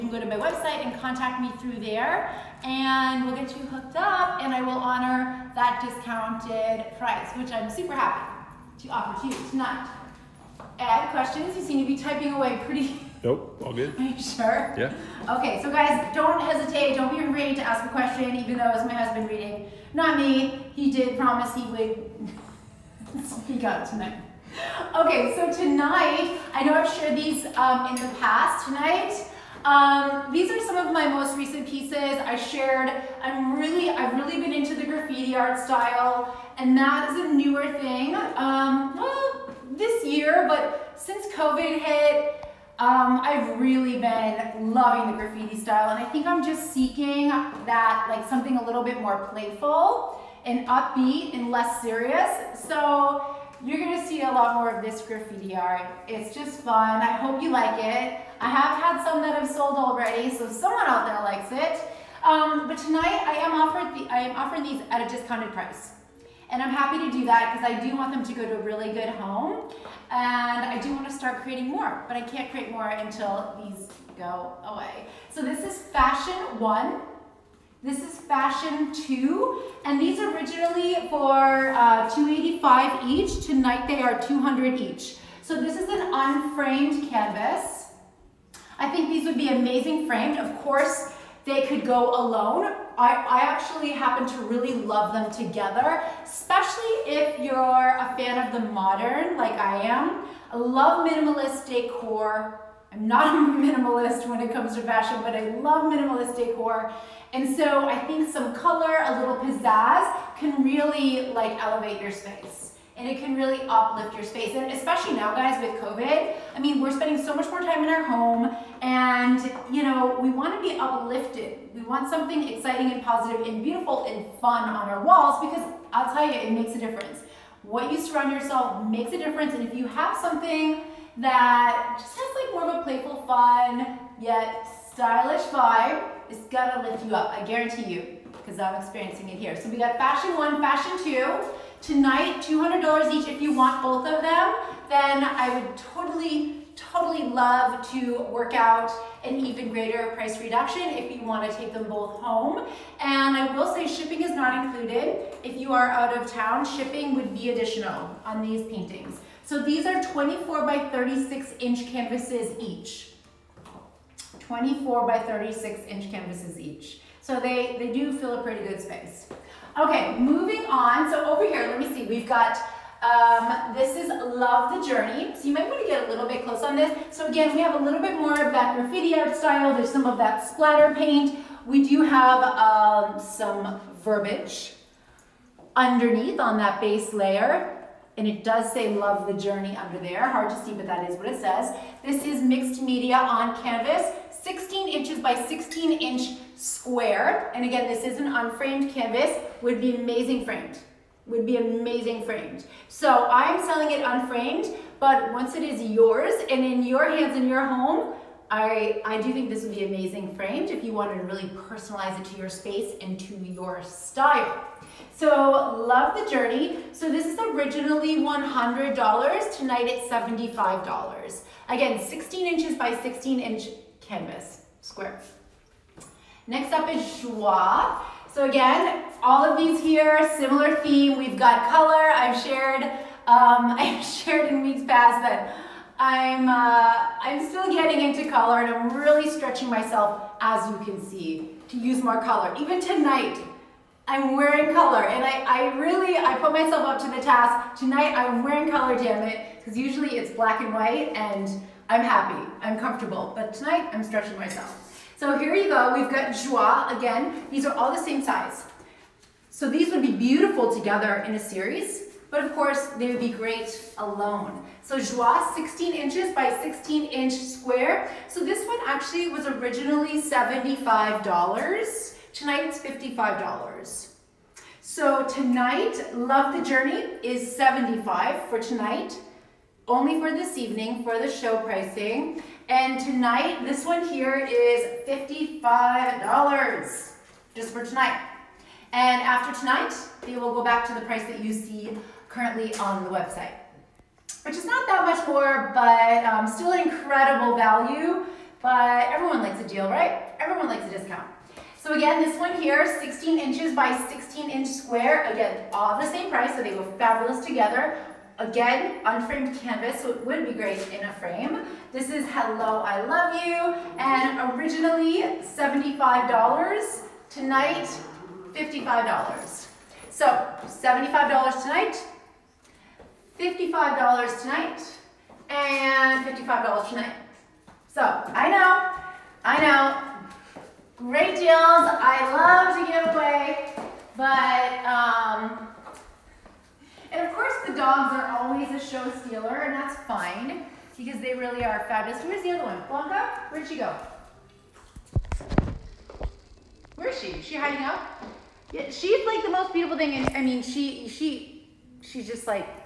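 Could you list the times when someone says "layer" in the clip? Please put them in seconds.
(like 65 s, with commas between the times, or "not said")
187 s.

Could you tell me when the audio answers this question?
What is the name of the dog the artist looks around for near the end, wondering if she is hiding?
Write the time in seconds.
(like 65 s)
342 s.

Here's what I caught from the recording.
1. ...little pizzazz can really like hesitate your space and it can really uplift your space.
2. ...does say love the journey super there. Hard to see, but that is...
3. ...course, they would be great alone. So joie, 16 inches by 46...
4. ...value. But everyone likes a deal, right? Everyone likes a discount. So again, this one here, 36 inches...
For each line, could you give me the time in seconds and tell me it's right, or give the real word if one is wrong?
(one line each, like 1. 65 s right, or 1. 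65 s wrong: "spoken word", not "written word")
1. 109 s wrong: "elevate", not "hesitate"
2. 188 s wrong: "under", not "super"
3. 262 s wrong: "16", not "46"
4. 297 s wrong: "16", not "36".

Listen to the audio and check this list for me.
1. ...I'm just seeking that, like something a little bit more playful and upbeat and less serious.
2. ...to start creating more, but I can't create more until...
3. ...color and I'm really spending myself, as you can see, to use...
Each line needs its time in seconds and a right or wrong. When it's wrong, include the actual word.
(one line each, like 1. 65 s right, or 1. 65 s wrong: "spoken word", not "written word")
1. 46 s right
2. 71 s right
3. 238 s wrong: "stretching", not "spending".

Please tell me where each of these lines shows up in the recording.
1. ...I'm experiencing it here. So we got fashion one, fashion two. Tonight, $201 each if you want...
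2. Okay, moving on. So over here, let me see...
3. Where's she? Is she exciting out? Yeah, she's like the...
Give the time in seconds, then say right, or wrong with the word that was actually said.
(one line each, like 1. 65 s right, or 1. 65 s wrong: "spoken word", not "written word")
1. 138 s wrong: "200", not "201"
2. 169 s right
3. 346 s wrong: "hiding", not "exciting".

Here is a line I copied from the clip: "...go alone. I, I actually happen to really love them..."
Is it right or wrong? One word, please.
right.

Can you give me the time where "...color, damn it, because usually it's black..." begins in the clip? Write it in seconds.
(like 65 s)
248 s.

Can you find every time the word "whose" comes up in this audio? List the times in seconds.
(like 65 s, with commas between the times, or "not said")
not said.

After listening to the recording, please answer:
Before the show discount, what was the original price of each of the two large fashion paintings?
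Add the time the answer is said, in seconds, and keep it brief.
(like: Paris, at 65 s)
$285, at 82 s.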